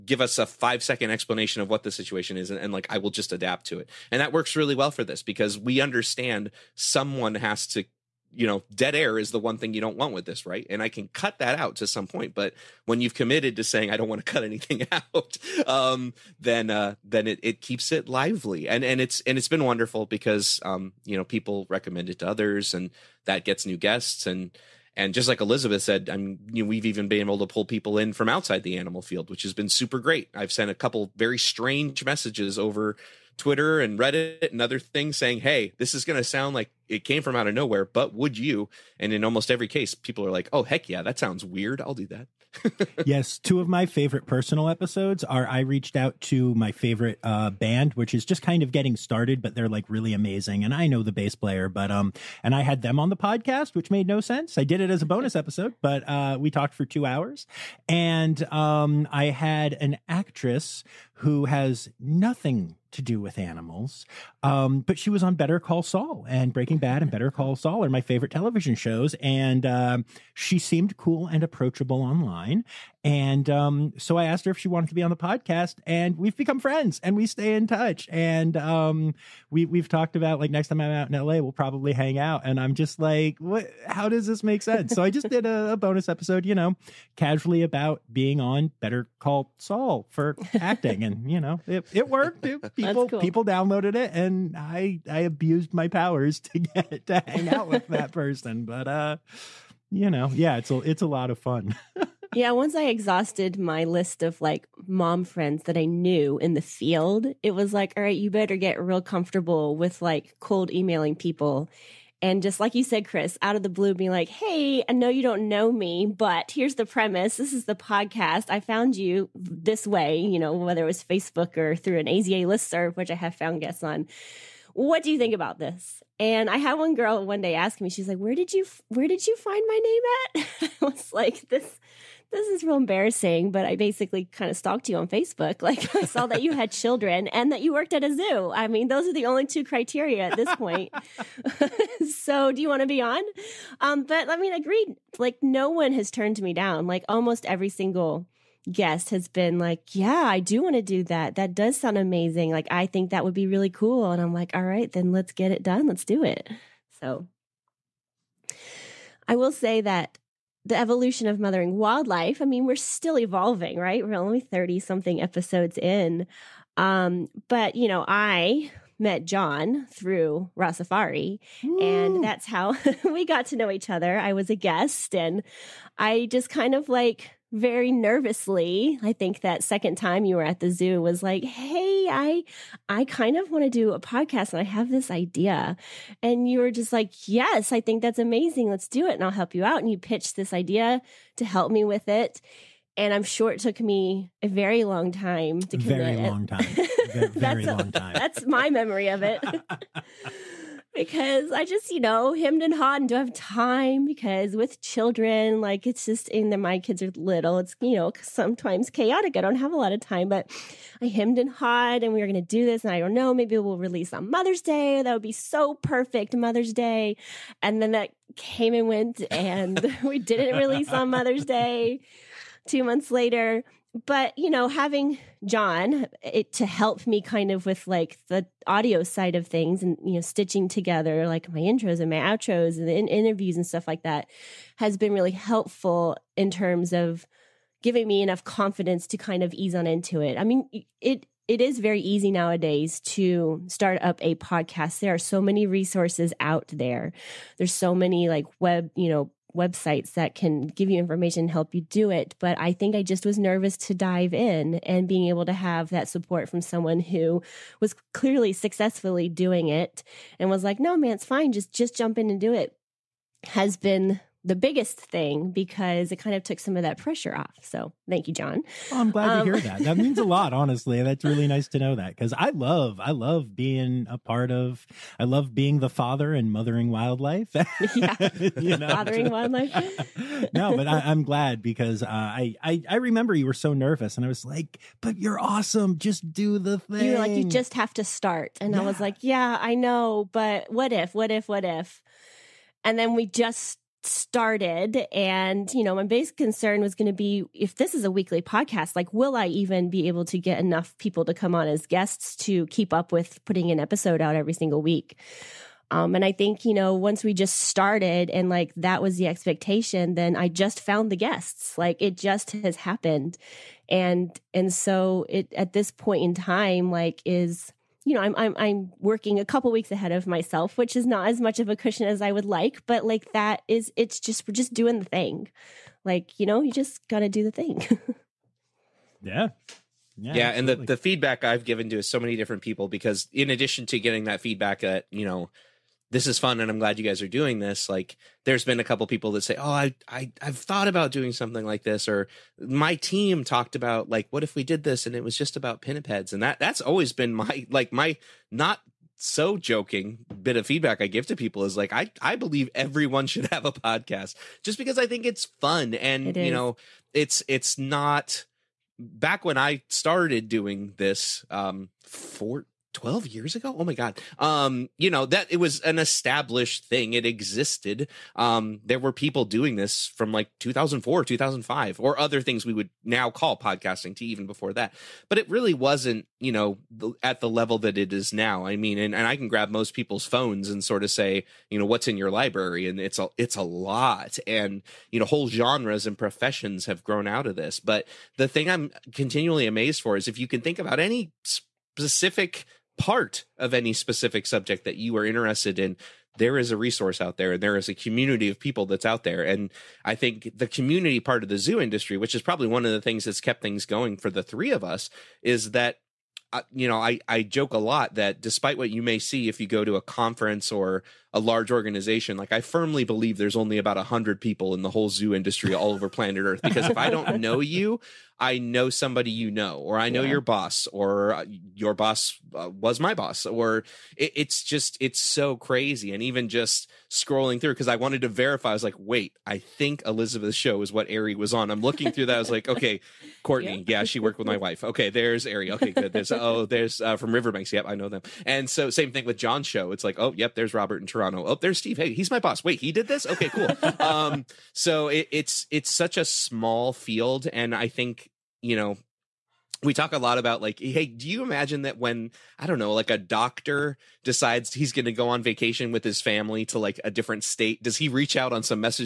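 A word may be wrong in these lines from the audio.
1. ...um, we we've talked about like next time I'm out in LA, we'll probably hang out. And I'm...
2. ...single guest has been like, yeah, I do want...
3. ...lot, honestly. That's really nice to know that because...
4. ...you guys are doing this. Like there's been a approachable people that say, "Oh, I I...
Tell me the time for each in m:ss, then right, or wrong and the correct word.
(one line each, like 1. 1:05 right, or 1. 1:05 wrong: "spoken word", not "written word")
1. 1:18 right
2. 2:27 right
3. 4:30 right
4. 5:36 wrong: "couple", not "approachable".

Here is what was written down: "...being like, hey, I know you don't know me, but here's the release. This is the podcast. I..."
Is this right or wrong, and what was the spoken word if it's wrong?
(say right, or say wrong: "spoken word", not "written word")
wrong: "premise", not "release".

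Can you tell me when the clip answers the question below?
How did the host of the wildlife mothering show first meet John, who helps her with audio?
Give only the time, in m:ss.
2:50.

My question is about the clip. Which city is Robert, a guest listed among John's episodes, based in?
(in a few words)
Toronto.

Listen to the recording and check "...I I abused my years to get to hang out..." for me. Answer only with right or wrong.
wrong.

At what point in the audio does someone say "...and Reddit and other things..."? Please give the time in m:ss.
0:33.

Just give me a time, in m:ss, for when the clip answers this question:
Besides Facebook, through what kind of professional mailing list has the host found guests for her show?
2:02.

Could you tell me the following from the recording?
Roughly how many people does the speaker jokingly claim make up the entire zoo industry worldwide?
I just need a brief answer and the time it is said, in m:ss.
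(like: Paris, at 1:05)
100, at 6:53.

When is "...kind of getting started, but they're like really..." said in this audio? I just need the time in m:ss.
0:48.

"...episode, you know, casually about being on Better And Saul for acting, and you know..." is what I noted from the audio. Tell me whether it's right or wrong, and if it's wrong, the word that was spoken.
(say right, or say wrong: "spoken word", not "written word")
wrong: "Call", not "And".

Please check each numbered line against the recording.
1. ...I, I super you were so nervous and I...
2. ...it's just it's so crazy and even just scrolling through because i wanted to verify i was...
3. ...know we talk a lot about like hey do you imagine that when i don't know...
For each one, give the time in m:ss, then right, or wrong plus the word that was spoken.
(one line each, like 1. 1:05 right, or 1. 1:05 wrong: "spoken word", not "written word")
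1. 4:42 wrong: "remember", not "super"
2. 7:04 right
3. 7:28 right.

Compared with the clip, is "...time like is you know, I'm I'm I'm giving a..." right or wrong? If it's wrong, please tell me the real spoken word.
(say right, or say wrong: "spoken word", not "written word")
wrong: "working", not "giving".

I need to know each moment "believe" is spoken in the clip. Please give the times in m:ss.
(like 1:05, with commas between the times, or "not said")
5:52, 6:53.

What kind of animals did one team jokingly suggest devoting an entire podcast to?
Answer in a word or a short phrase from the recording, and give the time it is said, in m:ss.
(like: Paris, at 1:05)
pinnipeds, at 5:45.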